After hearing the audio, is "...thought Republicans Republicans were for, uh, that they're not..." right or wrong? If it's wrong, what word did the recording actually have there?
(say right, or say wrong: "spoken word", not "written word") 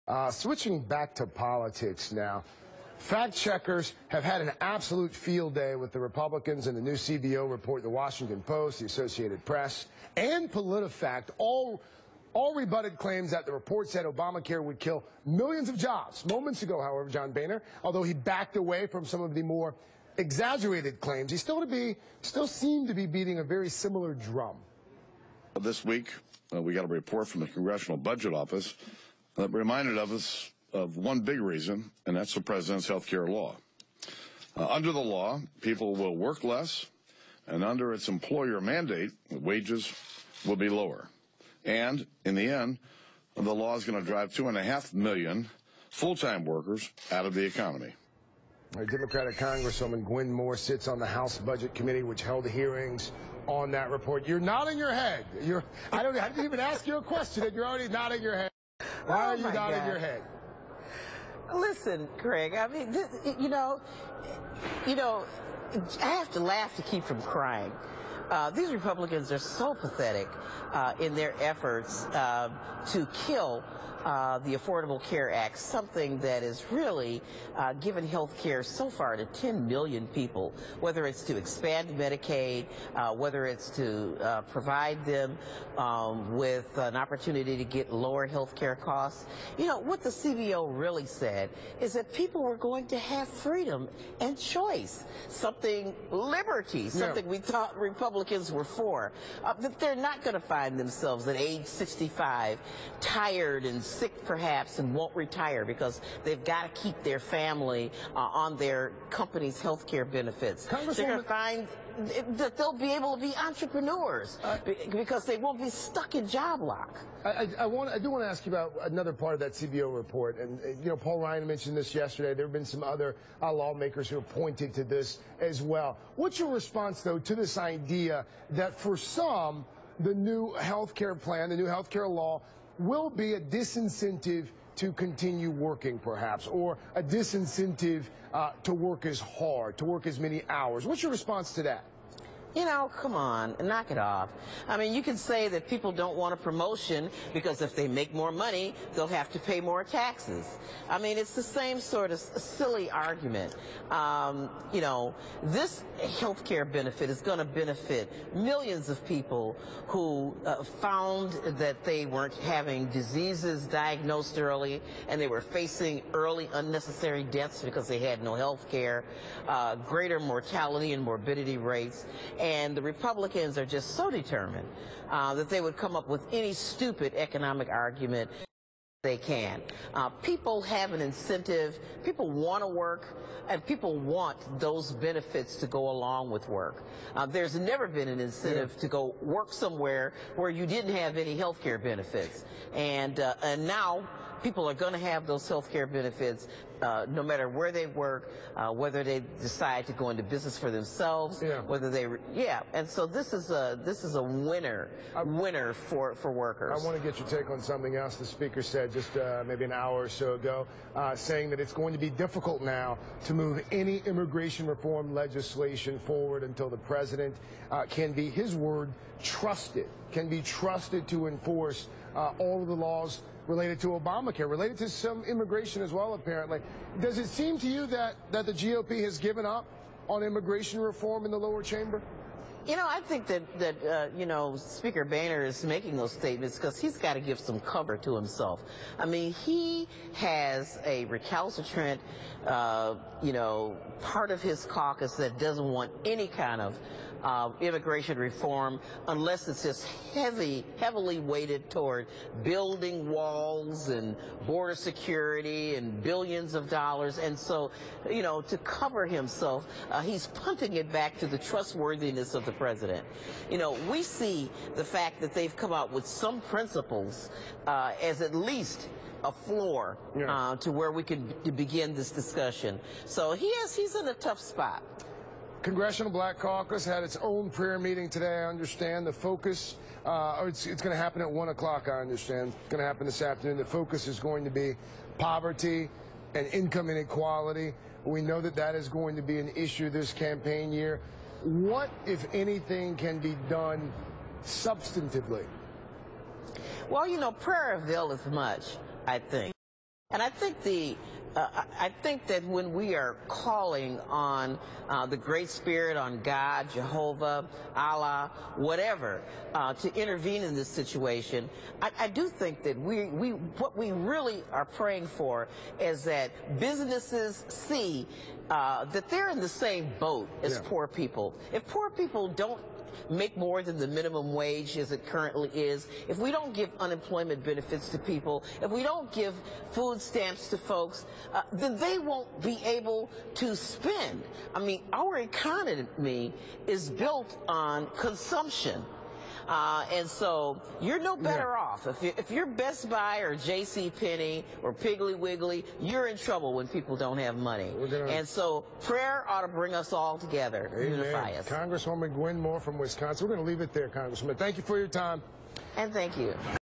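right.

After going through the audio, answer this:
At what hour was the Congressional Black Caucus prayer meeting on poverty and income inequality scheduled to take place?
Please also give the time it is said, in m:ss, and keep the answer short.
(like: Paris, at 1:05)
1 o'clock, at 4:41.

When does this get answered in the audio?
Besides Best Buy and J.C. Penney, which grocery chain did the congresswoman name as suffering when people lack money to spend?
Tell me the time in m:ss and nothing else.
5:44.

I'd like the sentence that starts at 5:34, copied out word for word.
I mean, our economy is built on consumption.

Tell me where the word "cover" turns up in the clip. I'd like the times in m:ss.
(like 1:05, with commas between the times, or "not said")
3:57, 4:18.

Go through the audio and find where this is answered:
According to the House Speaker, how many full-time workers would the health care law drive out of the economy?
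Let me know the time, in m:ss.
0:44.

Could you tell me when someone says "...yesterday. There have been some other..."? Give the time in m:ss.
2:01.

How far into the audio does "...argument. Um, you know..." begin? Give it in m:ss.
2:32.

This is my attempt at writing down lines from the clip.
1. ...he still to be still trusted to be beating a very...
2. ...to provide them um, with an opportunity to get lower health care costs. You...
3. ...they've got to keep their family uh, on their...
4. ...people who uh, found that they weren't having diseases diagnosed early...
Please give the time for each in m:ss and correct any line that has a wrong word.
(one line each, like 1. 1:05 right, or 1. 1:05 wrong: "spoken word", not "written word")
1. 0:21 wrong: "seemed", not "trusted"
2. 1:23 right
3. 1:46 right
4. 2:39 right.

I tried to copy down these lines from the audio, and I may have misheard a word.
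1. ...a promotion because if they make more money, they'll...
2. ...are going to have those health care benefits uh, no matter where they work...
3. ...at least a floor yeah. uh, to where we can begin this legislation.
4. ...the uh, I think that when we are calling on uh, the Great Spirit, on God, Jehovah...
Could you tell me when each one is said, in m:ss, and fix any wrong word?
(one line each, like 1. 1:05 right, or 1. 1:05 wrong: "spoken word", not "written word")
1. 2:26 right
2. 3:14 right
3. 4:28 wrong: "discussion", not "legislation"
4. 5:00 right.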